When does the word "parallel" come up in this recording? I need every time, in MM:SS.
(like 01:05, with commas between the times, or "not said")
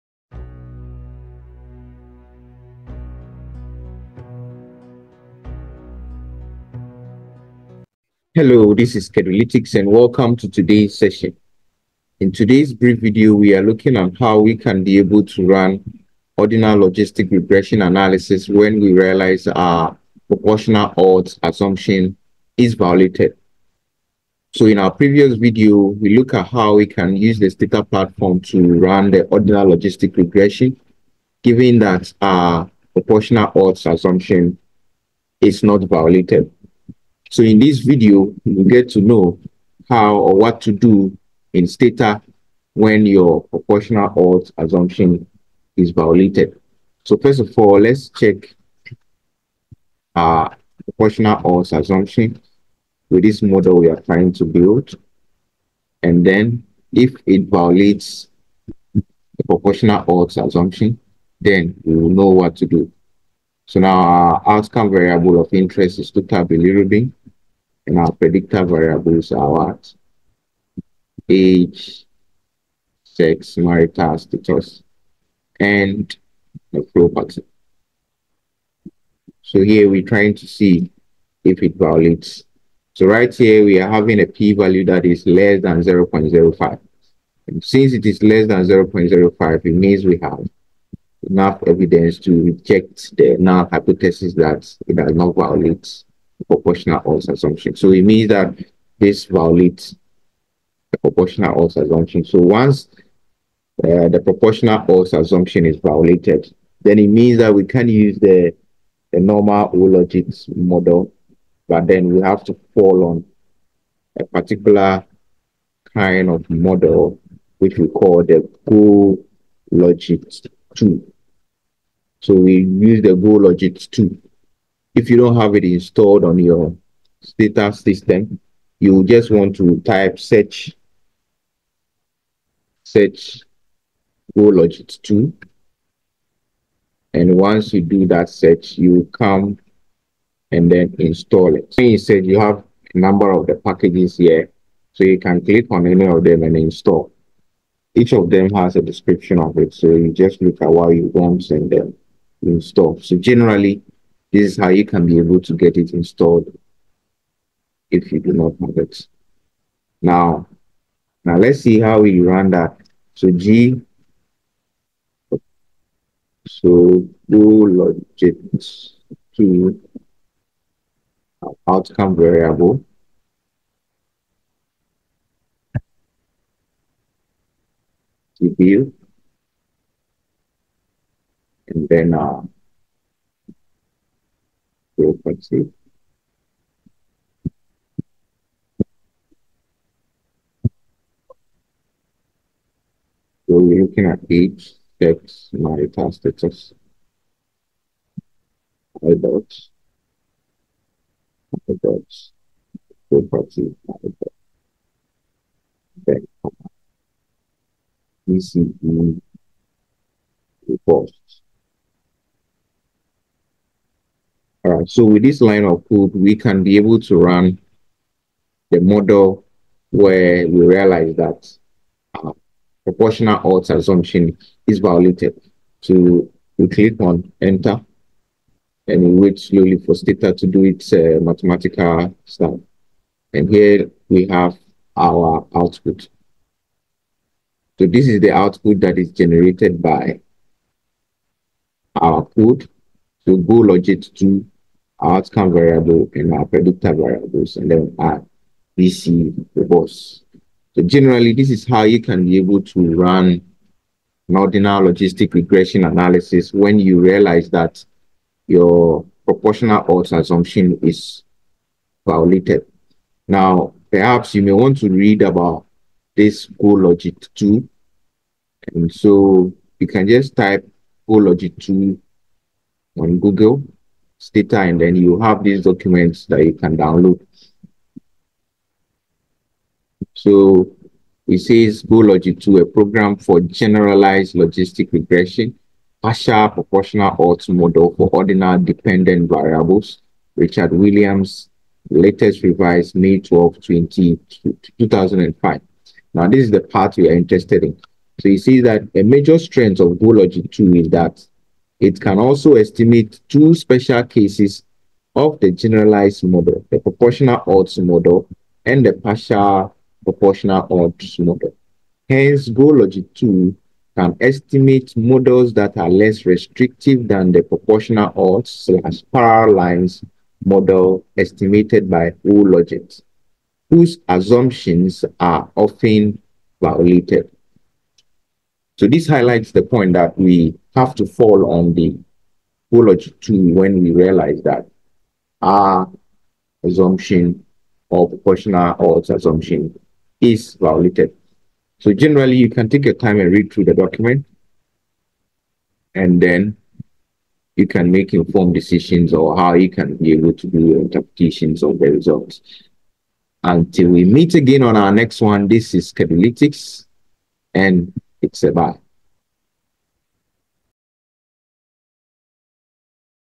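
05:19.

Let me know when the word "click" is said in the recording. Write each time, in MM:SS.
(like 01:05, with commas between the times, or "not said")
02:25, 03:46.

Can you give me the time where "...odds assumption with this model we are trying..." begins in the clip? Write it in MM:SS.
00:51.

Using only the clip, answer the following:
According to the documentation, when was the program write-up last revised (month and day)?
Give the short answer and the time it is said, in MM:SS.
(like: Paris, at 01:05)
May 12, at 04:52.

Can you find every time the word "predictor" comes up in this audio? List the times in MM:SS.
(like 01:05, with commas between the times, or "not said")
01:08, 04:06.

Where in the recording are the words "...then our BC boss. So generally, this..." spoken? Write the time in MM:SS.
04:07.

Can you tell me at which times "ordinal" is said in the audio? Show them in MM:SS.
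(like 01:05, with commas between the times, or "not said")
00:16, 00:29, 04:14, 04:48.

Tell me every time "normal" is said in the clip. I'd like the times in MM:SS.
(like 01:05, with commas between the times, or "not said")
01:49.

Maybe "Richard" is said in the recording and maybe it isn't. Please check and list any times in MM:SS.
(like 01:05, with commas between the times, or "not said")
04:50.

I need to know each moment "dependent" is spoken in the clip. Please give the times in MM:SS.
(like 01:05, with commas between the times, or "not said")
04:48.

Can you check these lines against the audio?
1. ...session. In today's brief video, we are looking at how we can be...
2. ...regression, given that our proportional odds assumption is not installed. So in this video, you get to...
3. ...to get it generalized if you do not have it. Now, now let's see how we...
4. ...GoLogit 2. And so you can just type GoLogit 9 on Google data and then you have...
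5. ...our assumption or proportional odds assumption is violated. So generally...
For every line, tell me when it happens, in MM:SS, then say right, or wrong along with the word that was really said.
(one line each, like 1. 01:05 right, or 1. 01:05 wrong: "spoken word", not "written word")
1. 00:10 right
2. 00:30 wrong: "violated", not "installed"
3. 02:35 wrong: "installed", not "generalized"
4. 04:26 wrong: "2", not "9"
5. 05:35 right.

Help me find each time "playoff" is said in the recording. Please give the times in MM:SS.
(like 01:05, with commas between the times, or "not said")
not said.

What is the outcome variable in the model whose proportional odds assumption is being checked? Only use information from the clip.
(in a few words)
Total bilirubin.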